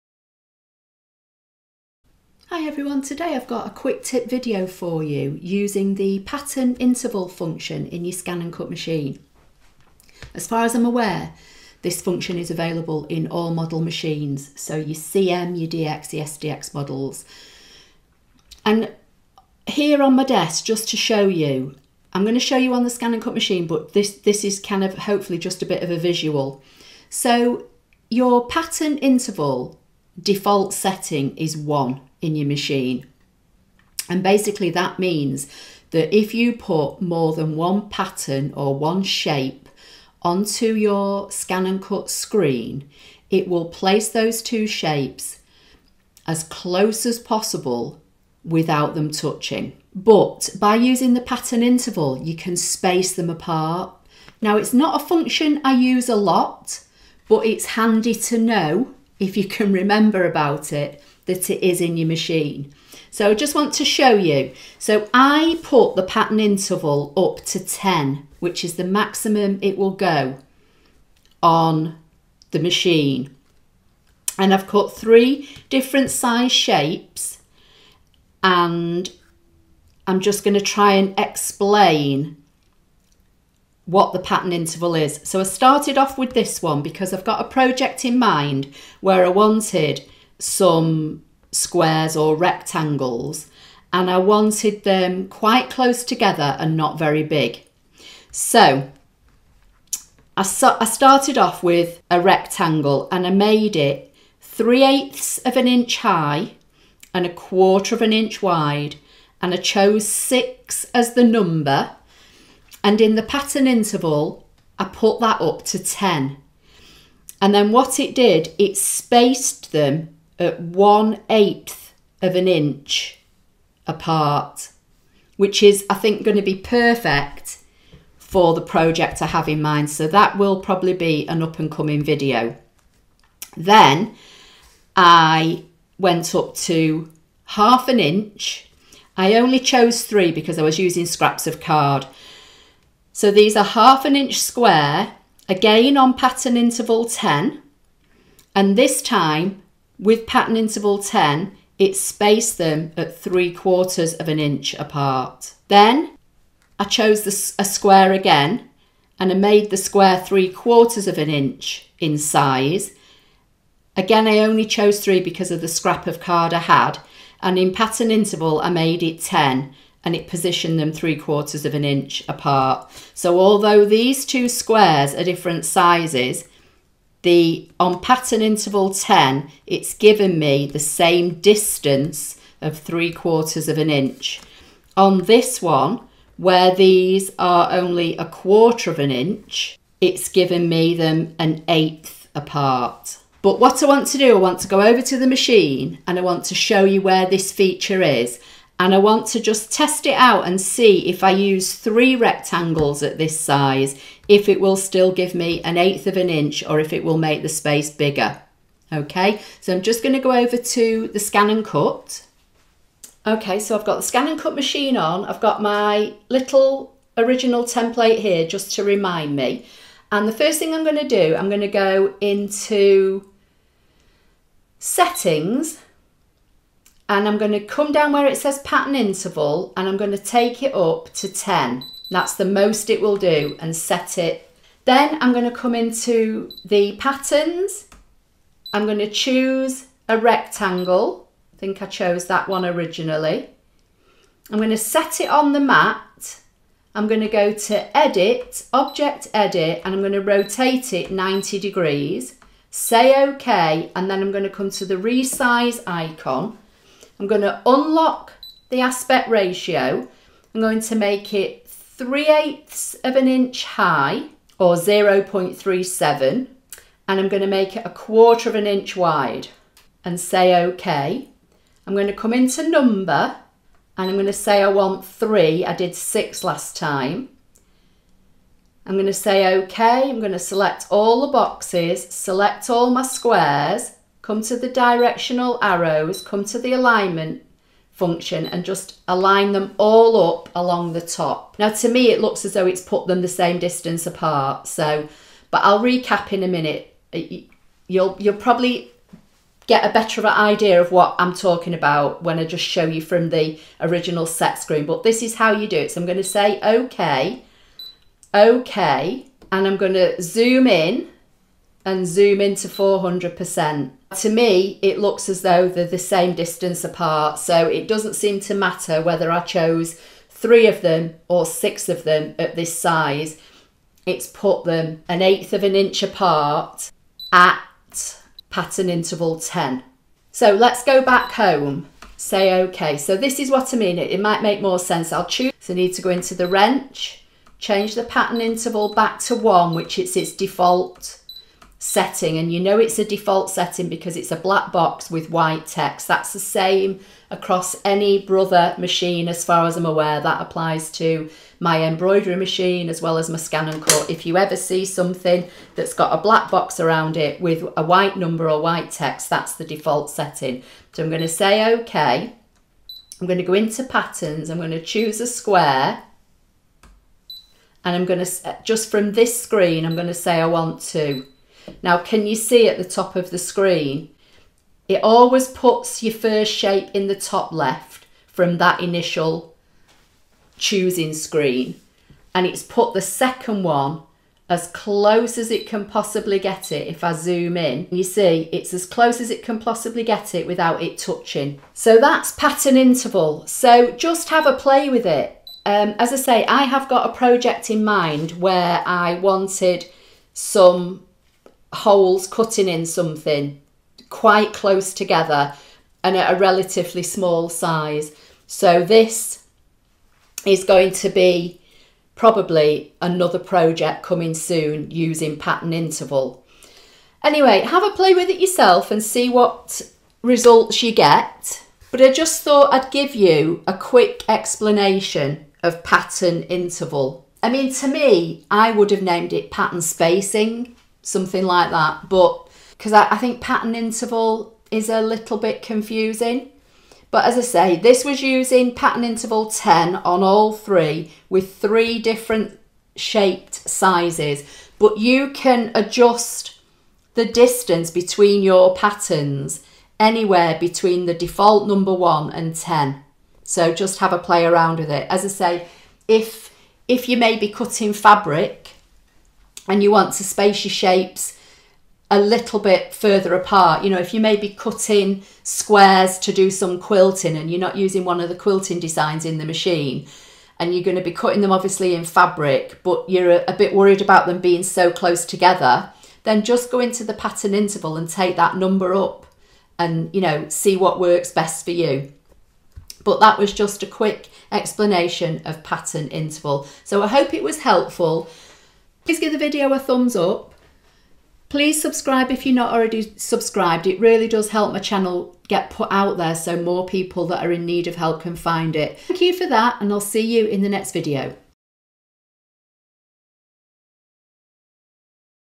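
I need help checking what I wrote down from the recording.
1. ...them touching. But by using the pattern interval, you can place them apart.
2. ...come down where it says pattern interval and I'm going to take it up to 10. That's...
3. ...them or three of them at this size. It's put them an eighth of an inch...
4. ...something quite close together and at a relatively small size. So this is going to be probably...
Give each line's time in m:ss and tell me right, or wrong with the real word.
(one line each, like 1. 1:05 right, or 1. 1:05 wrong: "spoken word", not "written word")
1. 0:48 wrong: "space", not "place"
2. 3:47 right
3. 5:20 wrong: "six", not "three"
4. 6:42 right.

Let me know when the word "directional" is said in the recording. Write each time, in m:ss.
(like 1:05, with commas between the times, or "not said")
4:44.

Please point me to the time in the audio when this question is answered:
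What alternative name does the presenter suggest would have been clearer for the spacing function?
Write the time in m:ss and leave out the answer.
7:09.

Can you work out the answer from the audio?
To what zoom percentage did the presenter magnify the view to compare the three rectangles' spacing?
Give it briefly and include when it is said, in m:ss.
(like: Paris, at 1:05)
400%, at 5:12.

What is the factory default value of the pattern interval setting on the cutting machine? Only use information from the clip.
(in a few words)
1.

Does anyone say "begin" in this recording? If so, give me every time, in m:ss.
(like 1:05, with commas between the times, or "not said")
not said.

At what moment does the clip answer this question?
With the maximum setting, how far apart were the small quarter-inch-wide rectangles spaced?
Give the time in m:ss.
2:00.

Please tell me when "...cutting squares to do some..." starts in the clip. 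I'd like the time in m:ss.
7:44.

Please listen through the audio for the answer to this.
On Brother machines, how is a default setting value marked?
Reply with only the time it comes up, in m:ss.
5:44.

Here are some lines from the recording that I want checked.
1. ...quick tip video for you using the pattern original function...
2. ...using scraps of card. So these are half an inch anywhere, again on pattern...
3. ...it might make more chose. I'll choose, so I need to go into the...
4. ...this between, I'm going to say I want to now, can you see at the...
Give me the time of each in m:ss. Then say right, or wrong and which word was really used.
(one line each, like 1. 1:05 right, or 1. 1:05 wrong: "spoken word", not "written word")
1. 0:03 wrong: "interval", not "original"
2. 2:20 wrong: "square", not "anywhere"
3. 5:34 wrong: "sense", not "chose"
4. 6:09 wrong: "screen", not "between".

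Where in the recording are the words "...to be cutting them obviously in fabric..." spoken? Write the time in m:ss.
7:50.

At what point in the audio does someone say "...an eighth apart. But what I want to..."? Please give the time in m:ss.
3:11.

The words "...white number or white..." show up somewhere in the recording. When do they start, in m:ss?
5:57.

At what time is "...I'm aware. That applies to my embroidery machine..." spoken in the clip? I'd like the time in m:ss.
5:49.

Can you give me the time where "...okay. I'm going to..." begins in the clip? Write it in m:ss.
6:01.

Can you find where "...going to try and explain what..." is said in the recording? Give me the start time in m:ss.
1:20.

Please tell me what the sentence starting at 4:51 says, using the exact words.
Now to me it looks as though it's put them the same distance apart so but I'll recap in a minute.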